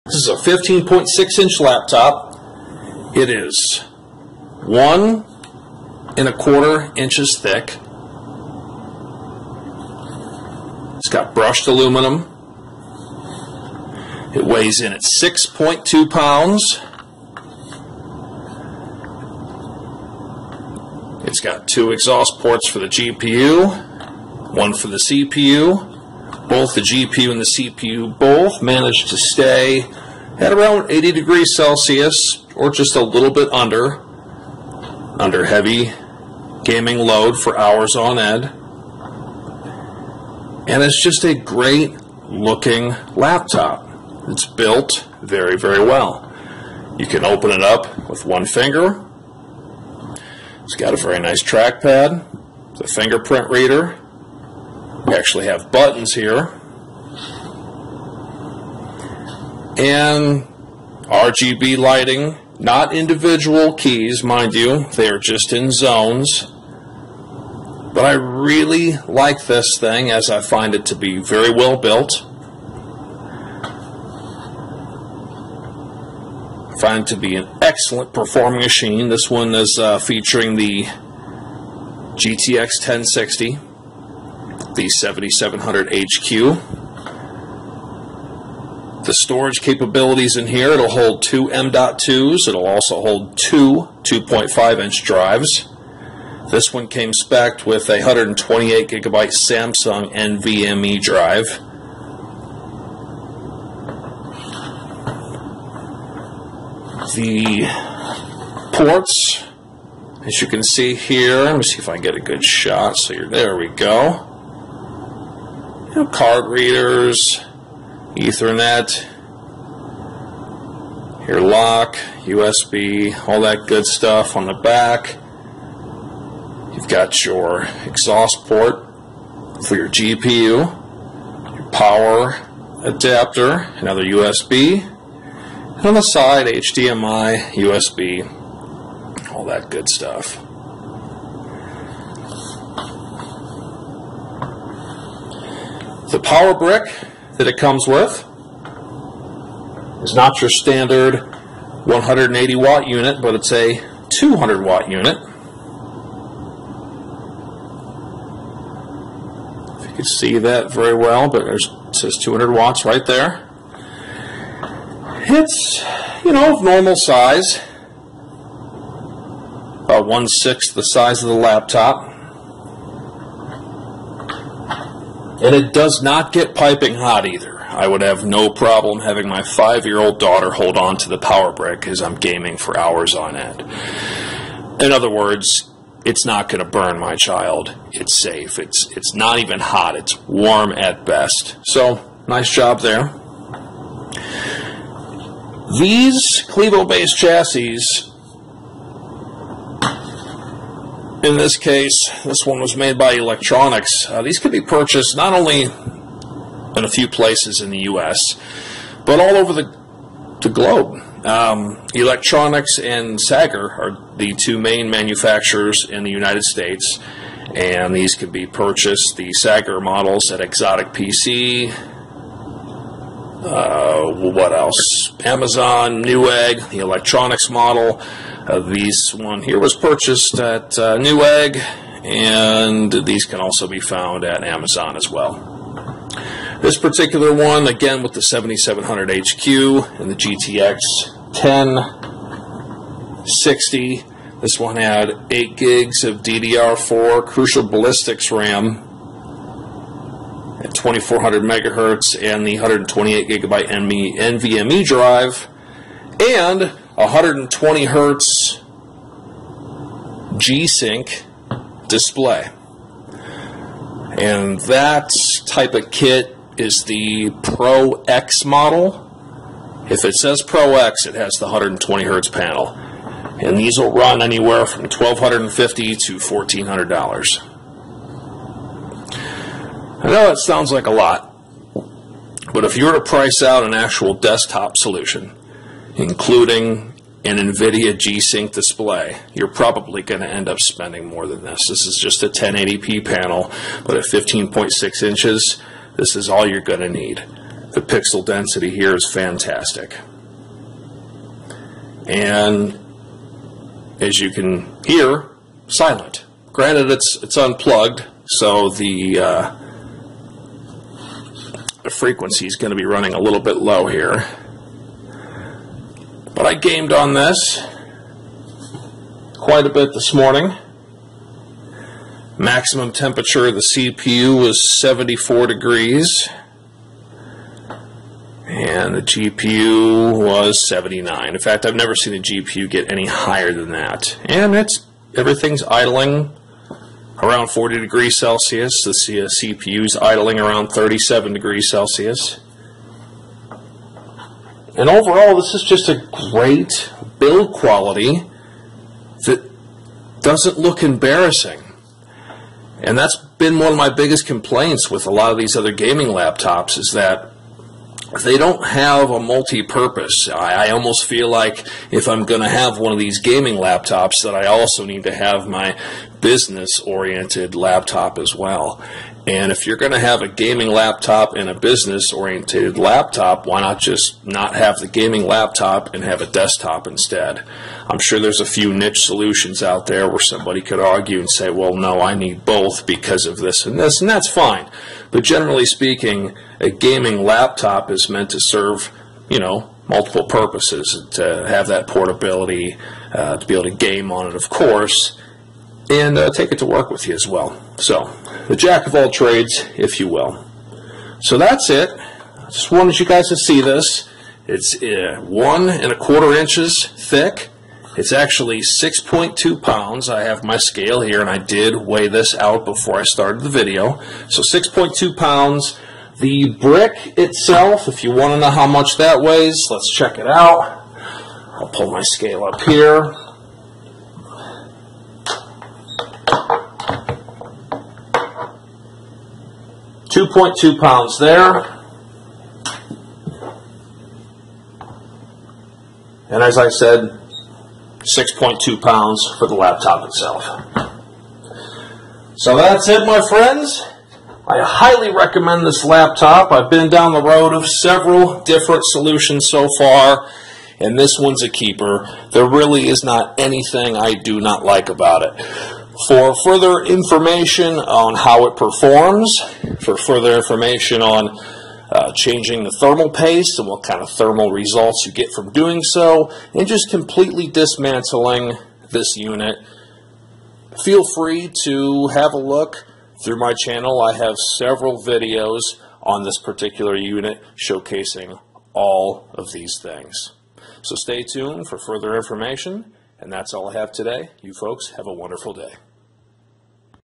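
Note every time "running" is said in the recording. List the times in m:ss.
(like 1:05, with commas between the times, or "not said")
5:12.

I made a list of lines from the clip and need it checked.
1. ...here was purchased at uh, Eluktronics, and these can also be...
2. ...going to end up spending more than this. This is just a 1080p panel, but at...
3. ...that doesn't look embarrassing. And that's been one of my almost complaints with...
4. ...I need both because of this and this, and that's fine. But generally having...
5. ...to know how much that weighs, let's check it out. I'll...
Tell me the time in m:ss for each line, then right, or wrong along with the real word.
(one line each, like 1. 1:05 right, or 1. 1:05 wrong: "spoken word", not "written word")
1. 3:49 wrong: "Newegg", not "Eluktronics"
2. 4:50 right
3. 5:49 wrong: "biggest", not "almost"
4. 6:22 wrong: "speaking", not "having"
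5. 6:58 right.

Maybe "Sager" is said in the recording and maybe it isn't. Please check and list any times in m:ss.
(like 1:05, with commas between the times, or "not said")
3:33, 3:39.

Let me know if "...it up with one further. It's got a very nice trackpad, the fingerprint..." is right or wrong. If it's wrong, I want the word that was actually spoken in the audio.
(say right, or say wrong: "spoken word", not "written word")
wrong: "finger", not "further".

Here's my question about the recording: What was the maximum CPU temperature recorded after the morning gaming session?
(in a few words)
74 degrees.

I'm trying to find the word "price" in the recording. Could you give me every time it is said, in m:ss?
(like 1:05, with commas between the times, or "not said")
4:43.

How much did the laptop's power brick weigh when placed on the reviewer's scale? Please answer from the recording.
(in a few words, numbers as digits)
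2.2 pounds.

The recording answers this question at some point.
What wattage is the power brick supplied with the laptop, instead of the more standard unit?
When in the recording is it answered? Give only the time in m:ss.
2:34.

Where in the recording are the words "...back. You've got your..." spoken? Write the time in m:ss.
2:04.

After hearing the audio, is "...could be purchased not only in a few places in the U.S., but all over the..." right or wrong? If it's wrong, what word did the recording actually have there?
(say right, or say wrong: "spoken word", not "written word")
right.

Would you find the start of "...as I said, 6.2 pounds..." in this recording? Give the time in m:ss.
7:16.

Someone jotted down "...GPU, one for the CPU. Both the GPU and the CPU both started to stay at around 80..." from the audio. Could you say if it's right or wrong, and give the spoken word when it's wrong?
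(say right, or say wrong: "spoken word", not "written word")
wrong: "managed", not "started".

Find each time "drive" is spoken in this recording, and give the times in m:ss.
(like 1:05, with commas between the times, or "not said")
1:35, 1:41, 4:14.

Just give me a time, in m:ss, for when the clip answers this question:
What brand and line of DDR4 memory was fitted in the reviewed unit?
4:07.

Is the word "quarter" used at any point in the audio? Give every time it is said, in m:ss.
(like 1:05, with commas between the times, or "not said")
0:06, 6:45.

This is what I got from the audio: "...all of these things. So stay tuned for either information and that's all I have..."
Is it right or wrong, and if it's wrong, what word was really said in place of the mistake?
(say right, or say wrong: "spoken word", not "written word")
wrong: "further", not "either".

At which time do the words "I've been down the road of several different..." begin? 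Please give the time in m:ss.
7:26.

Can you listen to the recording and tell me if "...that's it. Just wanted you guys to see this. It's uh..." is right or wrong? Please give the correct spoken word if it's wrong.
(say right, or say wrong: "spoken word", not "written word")
right.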